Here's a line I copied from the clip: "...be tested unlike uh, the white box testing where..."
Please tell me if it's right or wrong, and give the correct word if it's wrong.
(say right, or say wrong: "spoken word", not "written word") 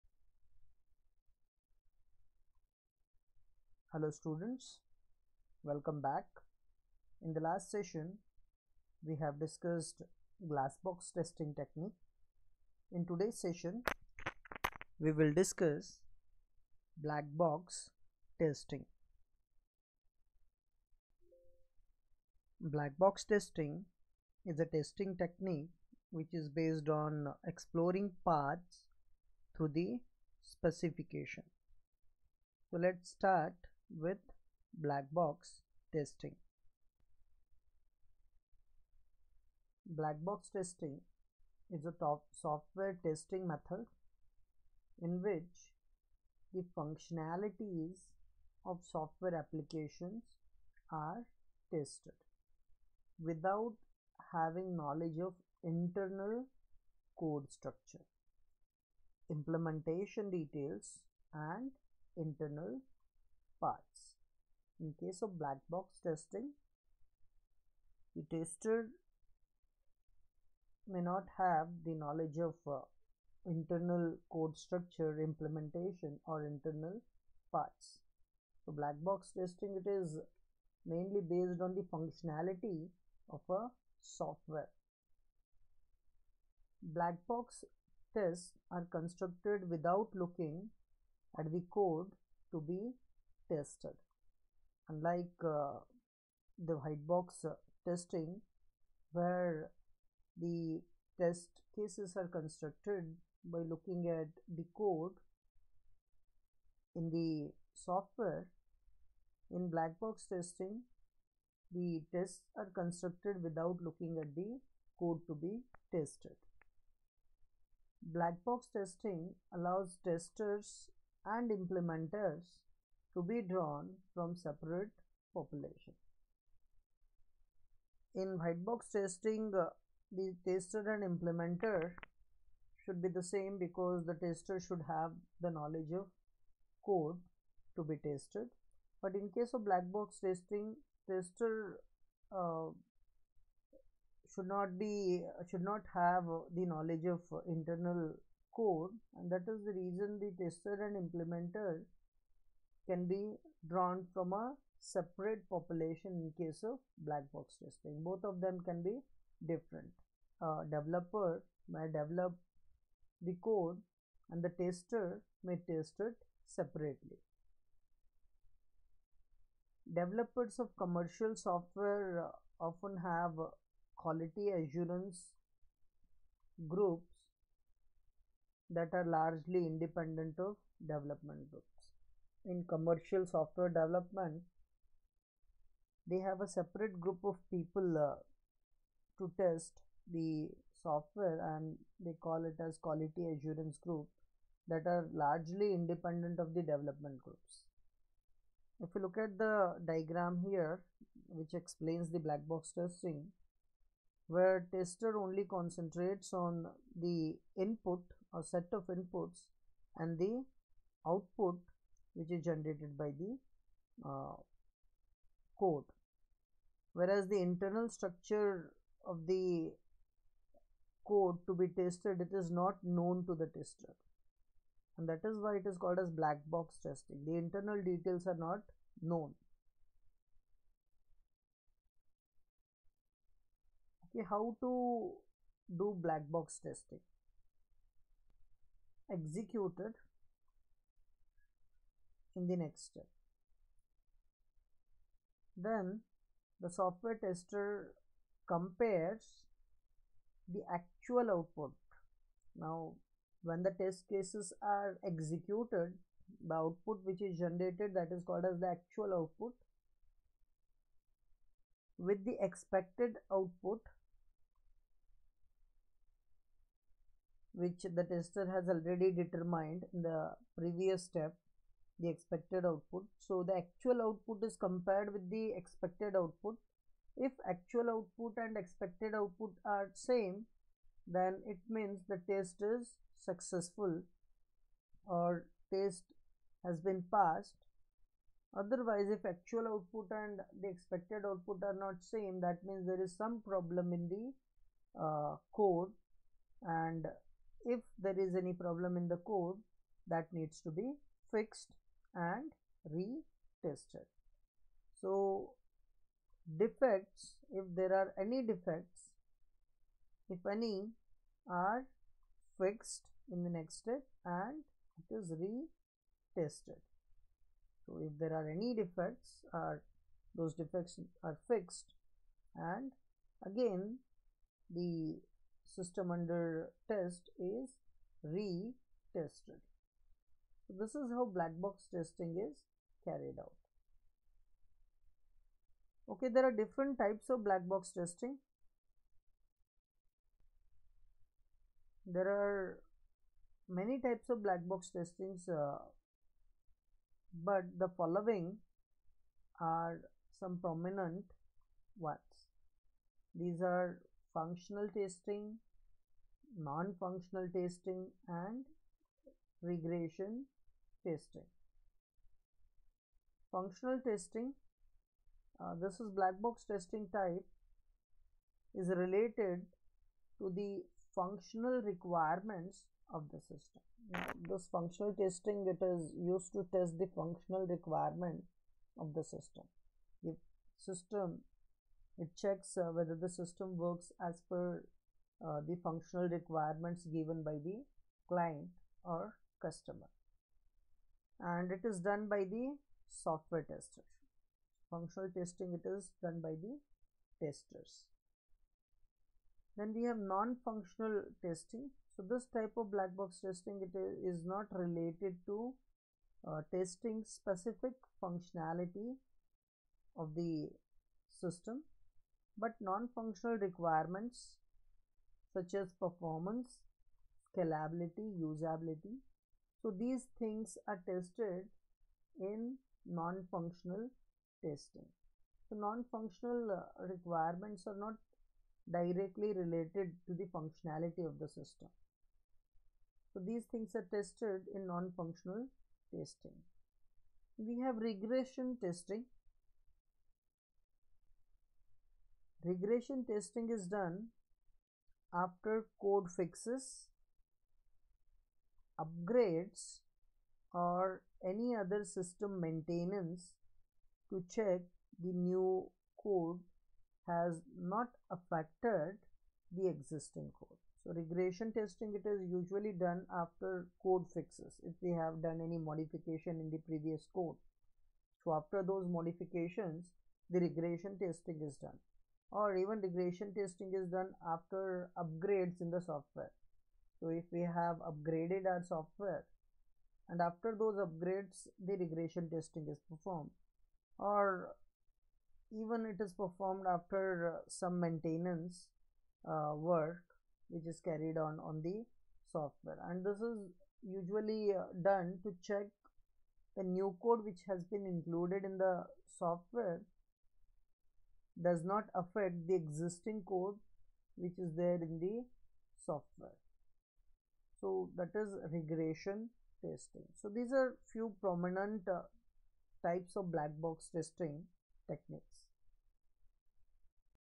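right.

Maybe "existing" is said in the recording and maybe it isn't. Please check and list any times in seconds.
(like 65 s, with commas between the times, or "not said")
459 s, 502 s.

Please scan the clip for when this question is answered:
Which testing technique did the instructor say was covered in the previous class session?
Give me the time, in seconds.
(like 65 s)
10 s.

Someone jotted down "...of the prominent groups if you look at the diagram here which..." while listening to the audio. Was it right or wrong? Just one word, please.
wrong.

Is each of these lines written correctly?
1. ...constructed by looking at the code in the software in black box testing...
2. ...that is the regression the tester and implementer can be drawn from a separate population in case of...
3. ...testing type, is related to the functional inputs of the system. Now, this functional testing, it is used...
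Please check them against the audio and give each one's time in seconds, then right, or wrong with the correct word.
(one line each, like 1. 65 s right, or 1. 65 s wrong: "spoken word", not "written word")
1. 102 s right
2. 149 s wrong: "reason", not "regression"
3. 366 s wrong: "requirements", not "inputs".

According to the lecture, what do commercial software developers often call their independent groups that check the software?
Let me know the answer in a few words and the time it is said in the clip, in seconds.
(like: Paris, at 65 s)
Quality assurance groups, at 173 s.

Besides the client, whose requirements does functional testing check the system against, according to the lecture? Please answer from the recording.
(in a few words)
Customer.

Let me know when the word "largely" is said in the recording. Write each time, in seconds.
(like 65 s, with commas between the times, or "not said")
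179 s, 195 s.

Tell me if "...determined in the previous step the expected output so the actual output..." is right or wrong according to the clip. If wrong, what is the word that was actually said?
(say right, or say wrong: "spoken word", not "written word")
right.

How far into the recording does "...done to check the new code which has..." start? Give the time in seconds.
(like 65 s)
495 s.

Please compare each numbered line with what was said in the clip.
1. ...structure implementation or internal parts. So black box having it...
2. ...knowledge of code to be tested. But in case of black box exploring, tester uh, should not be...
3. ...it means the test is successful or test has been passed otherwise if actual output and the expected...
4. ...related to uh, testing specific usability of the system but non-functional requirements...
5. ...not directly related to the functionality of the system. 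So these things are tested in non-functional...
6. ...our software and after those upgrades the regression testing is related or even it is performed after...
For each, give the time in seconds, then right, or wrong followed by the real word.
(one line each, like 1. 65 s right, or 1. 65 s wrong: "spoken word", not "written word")
1. 74 s wrong: "testing", not "having"
2. 135 s wrong: "testing", not "exploring"
3. 281 s right
4. 404 s wrong: "functionality", not "usability"
5. 427 s right
6. 478 s wrong: "performed", not "related".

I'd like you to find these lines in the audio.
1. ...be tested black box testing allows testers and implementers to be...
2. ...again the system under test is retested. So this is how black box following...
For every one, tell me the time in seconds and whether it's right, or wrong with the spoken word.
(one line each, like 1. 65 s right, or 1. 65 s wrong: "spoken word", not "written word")
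1. 115 s right
2. 323 s wrong: "testing", not "following".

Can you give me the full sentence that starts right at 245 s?
Then the software tester compares the actual output.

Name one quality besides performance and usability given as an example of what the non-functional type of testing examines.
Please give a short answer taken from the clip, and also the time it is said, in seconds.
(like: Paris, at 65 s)
Scalability, at 417 s.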